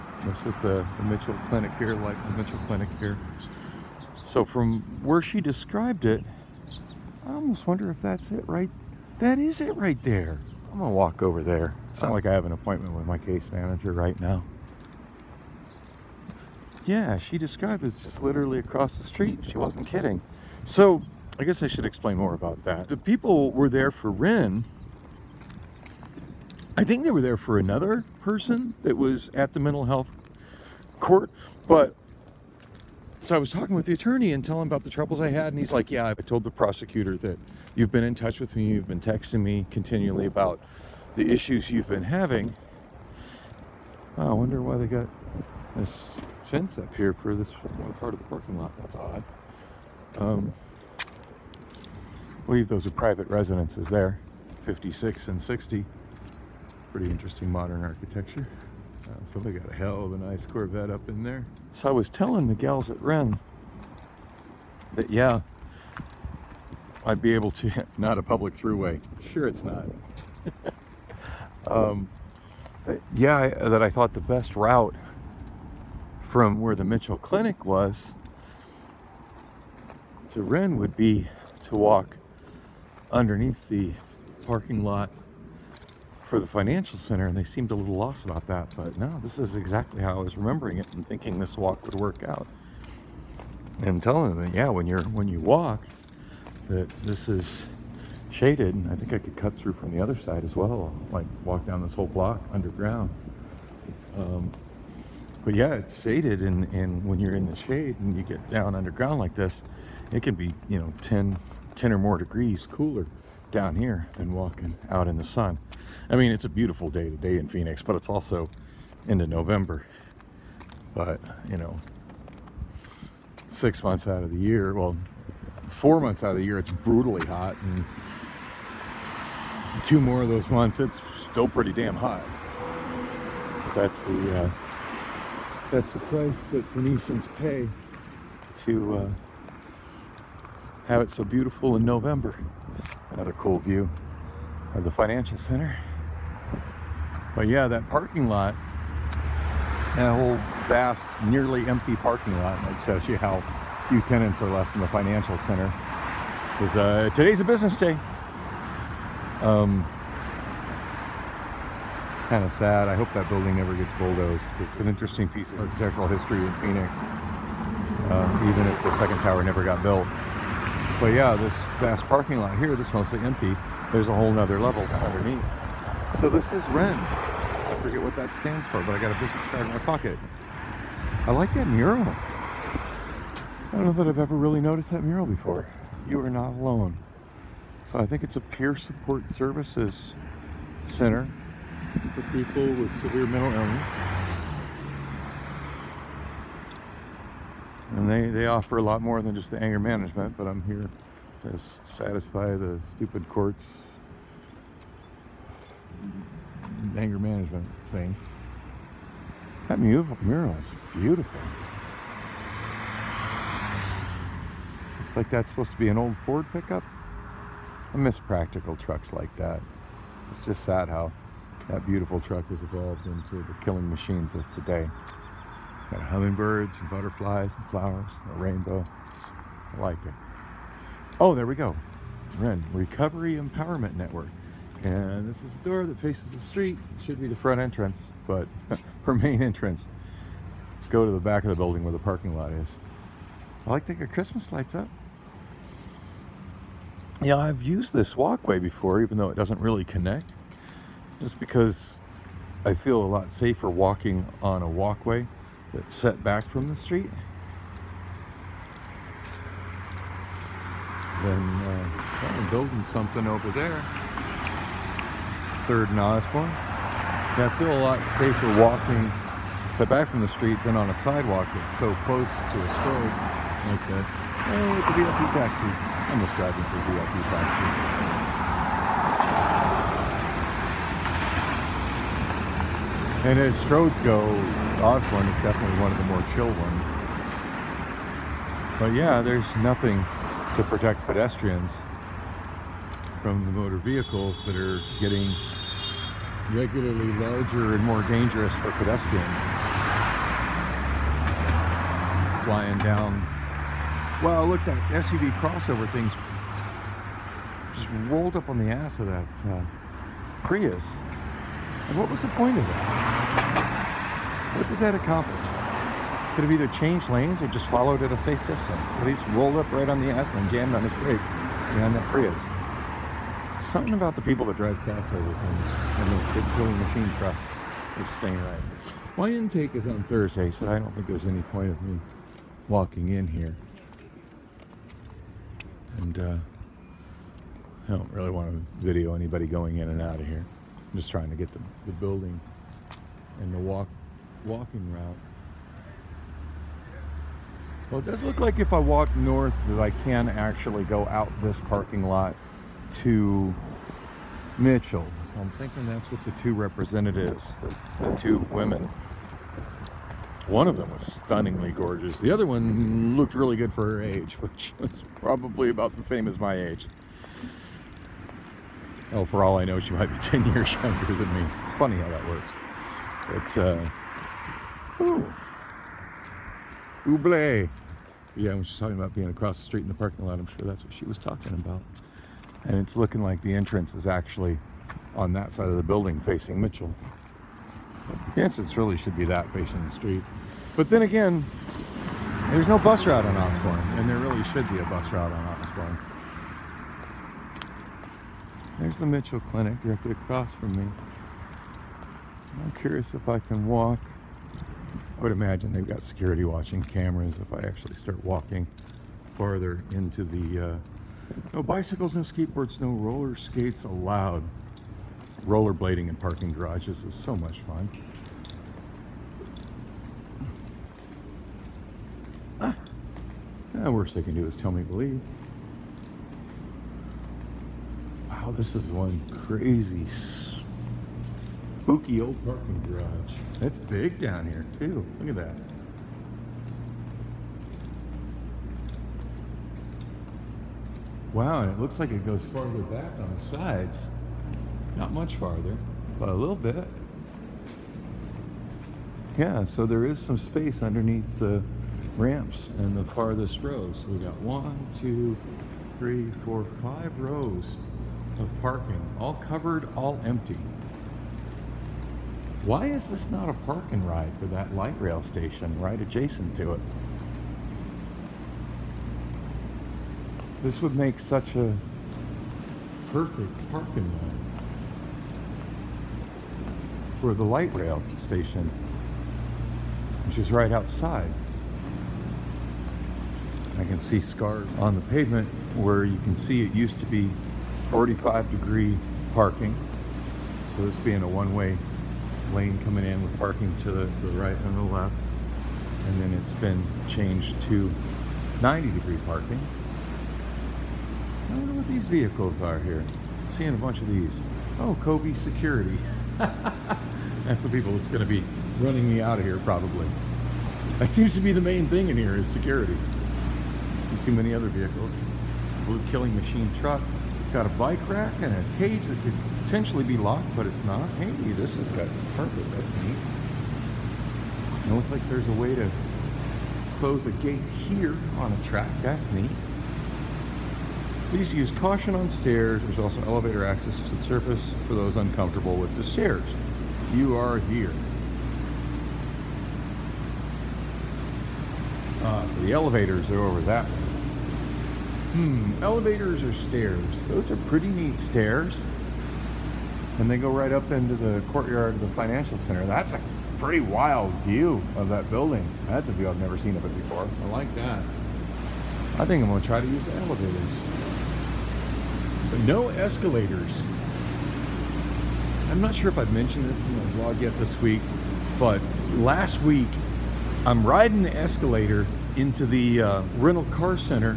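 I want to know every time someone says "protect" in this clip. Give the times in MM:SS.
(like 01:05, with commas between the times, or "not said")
04:50.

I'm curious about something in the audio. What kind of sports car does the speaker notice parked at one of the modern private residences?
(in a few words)
Corvette.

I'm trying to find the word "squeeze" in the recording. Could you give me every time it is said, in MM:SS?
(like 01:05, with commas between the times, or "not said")
not said.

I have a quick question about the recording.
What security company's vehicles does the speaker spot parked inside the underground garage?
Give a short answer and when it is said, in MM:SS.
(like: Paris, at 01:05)
Kobe Security, at 08:25.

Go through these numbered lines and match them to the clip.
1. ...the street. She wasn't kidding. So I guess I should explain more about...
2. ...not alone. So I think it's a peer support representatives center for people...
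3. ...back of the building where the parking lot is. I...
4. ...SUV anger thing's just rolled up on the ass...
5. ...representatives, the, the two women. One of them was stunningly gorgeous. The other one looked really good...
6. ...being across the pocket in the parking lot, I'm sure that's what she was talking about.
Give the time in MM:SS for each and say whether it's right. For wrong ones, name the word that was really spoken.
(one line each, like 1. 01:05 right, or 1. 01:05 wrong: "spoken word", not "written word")
1. 00:18 right
2. 03:06 wrong: "services", not "representatives"
3. 04:01 right
4. 05:04 wrong: "crossover", not "anger"
5. 05:56 right
6. 06:19 wrong: "street", not "pocket".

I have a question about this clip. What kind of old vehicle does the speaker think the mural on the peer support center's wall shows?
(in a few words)
Ford pickup.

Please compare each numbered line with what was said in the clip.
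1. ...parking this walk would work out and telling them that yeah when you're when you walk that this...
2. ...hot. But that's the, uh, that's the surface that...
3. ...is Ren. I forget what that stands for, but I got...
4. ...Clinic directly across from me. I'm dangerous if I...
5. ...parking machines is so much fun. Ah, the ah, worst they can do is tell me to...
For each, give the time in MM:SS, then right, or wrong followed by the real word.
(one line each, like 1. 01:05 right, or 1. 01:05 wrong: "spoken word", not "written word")
1. 01:31 wrong: "thinking", not "parking"
2. 02:11 wrong: "price", not "surface"
3. 02:56 right
4. 06:39 wrong: "curious", not "dangerous"
5. 06:56 wrong: "garages", not "machines".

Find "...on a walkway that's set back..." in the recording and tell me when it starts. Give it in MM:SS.
04:14.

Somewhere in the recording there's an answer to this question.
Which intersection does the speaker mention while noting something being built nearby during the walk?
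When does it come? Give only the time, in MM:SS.
04:25.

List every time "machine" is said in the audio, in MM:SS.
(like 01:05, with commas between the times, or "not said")
03:43, 05:26, 08:36.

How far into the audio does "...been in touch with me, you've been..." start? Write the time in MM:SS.
00:37.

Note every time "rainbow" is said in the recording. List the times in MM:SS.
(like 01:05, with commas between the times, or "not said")
03:48.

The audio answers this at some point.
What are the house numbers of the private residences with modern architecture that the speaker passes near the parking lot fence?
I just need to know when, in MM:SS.
00:54.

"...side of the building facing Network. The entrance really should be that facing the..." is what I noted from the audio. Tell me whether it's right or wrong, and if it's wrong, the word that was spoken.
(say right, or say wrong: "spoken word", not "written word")
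wrong: "Mitchell", not "Network".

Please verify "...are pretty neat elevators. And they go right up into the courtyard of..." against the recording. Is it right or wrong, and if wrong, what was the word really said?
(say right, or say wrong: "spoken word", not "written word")
wrong: "stairs", not "elevators".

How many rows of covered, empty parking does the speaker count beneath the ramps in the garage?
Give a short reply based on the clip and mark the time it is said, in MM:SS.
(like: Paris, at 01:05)
5, at 07:36.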